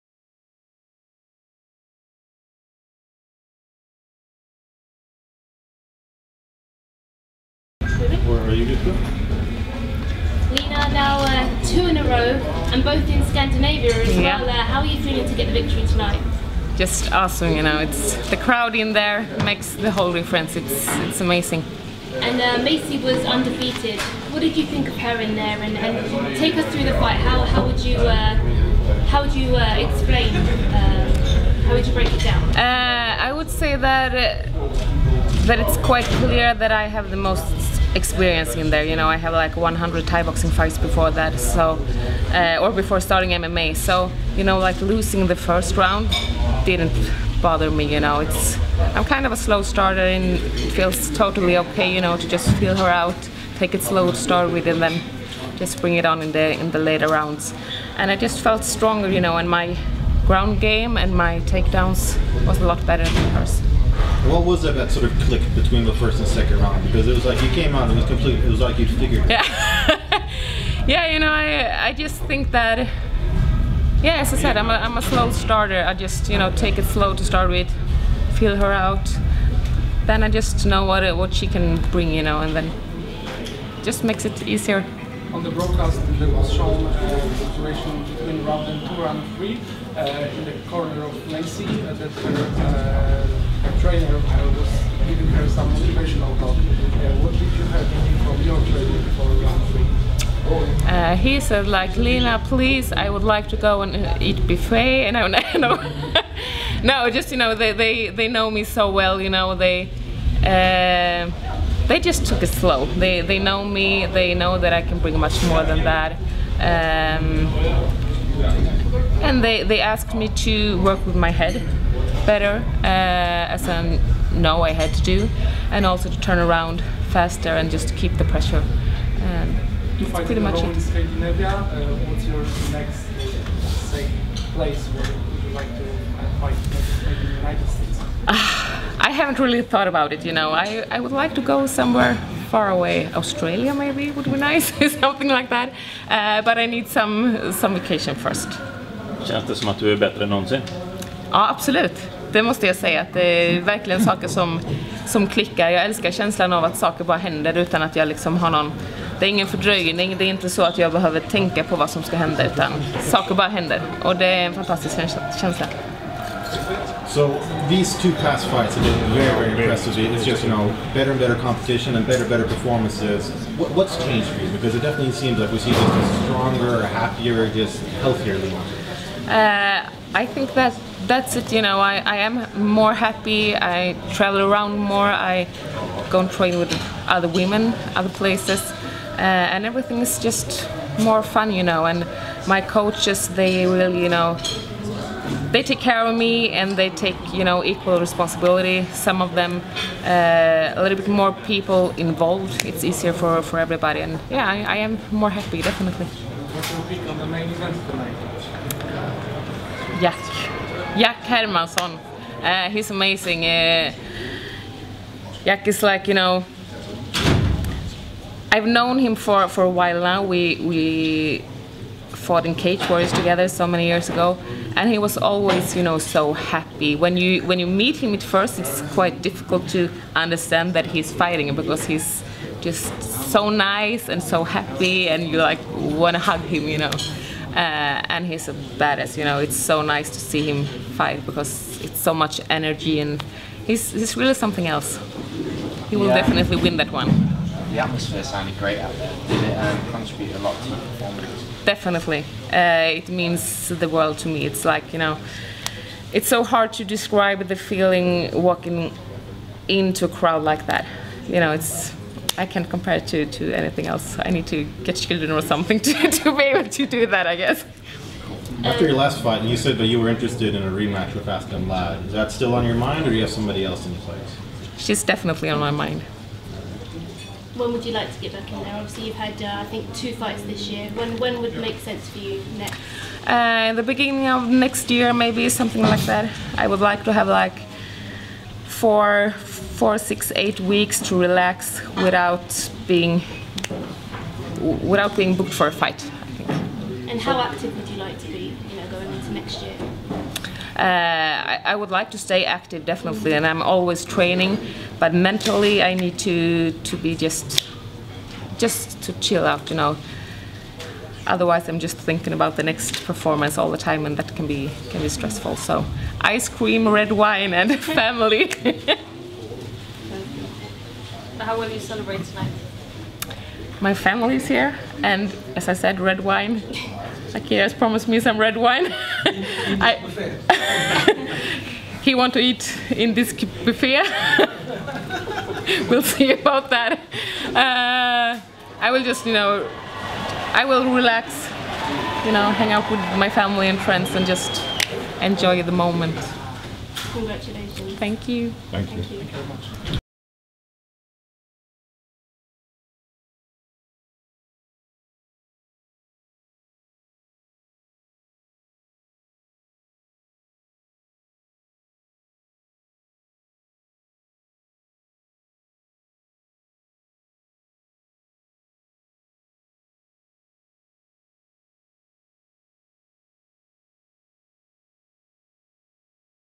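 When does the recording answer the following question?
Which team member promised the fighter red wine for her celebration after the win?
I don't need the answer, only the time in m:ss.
5:27.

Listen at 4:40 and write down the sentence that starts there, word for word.
When, when would make sense for you next?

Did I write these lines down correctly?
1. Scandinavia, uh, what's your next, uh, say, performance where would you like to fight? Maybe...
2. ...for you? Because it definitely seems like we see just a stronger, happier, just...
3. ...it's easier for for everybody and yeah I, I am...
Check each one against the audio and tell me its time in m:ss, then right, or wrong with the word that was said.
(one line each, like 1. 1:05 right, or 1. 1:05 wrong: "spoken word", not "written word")
1. 2:10 wrong: "place", not "performance"
2. 2:54 right
3. 3:22 right.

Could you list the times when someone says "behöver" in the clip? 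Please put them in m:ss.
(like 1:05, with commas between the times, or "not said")
2:40.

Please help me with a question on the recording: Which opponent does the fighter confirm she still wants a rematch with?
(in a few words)
Aspen Ladd.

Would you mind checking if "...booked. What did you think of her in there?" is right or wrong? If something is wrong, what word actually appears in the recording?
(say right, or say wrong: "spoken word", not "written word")
wrong: "undefeated", not "booked".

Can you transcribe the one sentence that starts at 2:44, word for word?
Och det är en fantastisk känsla.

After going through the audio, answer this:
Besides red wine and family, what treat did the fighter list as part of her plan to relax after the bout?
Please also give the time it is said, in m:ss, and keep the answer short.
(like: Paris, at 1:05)
ice cream, at 5:16.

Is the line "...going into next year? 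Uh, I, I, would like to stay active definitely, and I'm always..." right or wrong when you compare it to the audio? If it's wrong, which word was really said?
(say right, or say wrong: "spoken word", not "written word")
right.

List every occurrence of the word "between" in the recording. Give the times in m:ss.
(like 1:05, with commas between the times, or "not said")
1:05, 1:28.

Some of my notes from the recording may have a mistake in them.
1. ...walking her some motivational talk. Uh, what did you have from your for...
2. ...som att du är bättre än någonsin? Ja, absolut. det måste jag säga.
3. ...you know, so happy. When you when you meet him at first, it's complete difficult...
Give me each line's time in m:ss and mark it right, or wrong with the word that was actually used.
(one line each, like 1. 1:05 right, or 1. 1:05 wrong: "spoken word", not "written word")
1. 1:35 wrong: "giving", not "walking"
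2. 2:29 right
3. 3:45 wrong: "quite", not "complete".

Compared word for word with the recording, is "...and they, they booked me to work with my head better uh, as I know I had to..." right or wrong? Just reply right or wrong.
wrong.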